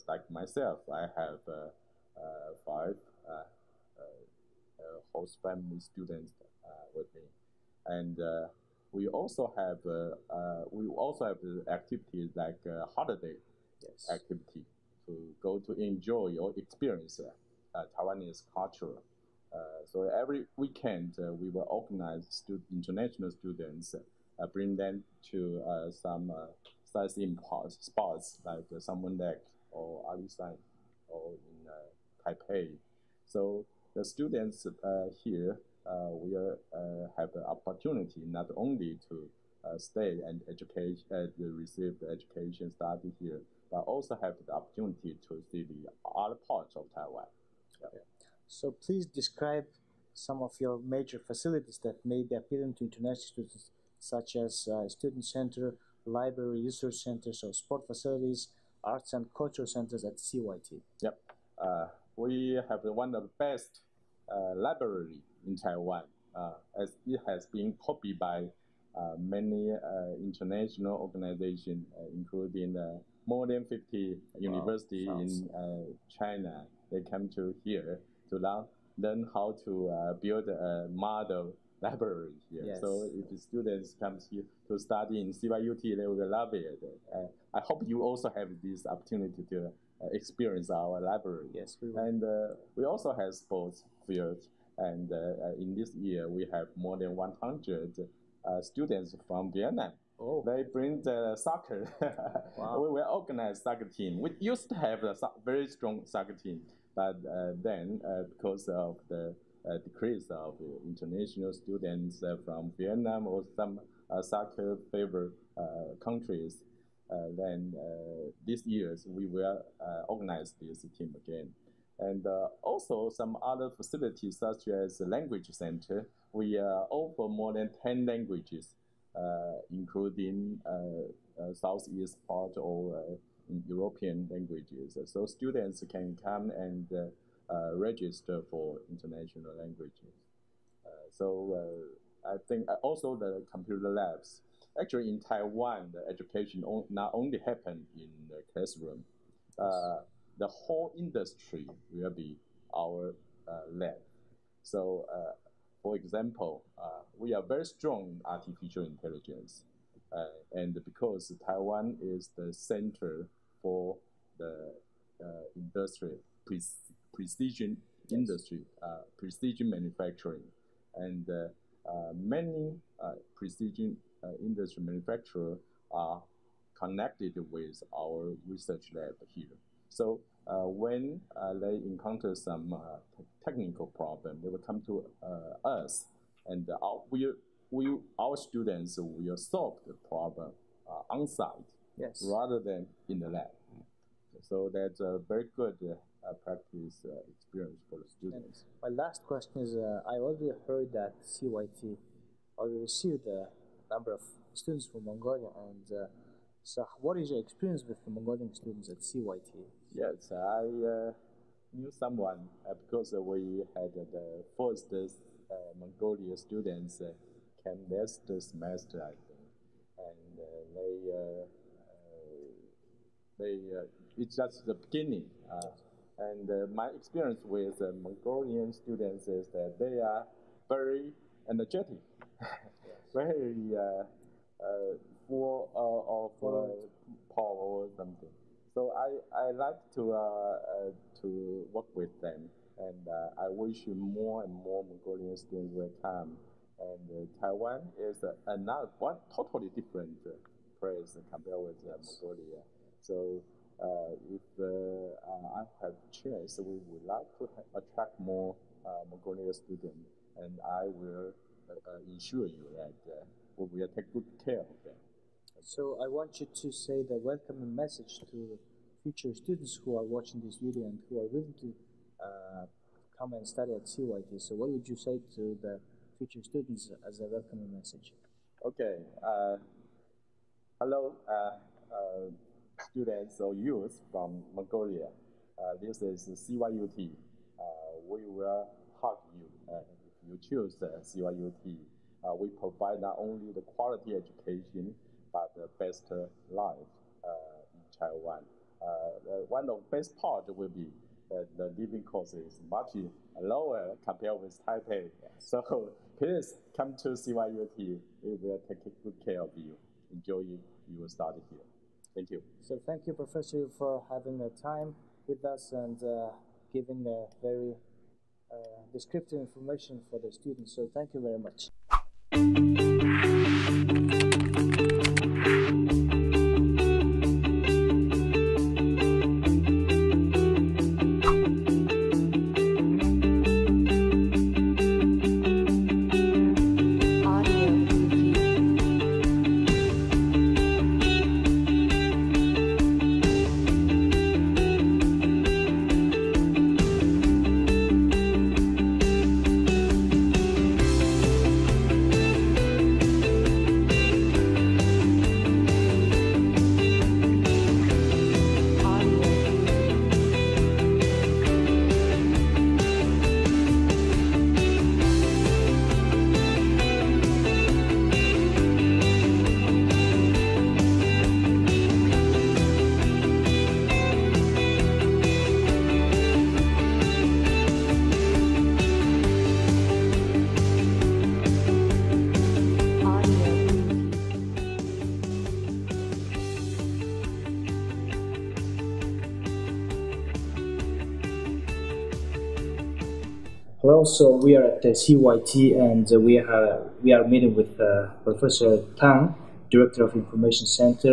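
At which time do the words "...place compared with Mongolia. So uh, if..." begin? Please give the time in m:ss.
4:10.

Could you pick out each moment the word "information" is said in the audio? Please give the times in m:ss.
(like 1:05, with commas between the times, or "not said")
5:19, 6:40.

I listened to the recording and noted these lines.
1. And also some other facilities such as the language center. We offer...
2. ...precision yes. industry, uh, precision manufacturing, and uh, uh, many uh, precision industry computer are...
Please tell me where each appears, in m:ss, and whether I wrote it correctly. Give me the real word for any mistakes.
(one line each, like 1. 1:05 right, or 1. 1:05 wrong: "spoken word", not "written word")
1. 2:01 right
2. 2:47 wrong: "manufacturer", not "computer".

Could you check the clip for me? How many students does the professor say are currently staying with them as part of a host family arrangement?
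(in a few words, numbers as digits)
5.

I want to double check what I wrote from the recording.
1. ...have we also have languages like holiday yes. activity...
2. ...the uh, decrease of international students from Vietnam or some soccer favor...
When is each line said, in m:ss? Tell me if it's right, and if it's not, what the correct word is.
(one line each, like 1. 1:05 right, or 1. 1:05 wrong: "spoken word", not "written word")
1. 0:09 wrong: "activities", not "languages"
2. 1:49 right.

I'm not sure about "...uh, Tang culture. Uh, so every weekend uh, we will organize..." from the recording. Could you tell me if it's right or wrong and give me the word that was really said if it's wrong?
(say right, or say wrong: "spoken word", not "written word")
wrong: "Taiwanese", not "Tang".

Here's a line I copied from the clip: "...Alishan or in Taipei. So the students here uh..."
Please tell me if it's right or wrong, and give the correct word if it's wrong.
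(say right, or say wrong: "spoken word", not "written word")
right.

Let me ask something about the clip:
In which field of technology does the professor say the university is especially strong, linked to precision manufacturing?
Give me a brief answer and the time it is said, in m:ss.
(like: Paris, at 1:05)
Artificial intelligence, at 2:38.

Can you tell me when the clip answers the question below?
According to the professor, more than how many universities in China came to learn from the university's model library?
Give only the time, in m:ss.
1:13.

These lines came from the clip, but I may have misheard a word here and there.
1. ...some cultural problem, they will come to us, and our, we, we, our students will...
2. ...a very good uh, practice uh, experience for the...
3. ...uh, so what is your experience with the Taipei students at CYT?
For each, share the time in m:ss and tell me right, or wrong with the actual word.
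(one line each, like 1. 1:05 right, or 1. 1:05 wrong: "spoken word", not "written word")
1. 3:02 wrong: "technical", not "cultural"
2. 3:14 right
3. 3:25 wrong: "Mongolian", not "Taipei".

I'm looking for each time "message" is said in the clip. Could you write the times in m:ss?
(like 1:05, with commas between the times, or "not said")
4:27, 4:37.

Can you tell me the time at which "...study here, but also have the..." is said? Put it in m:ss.
0:42.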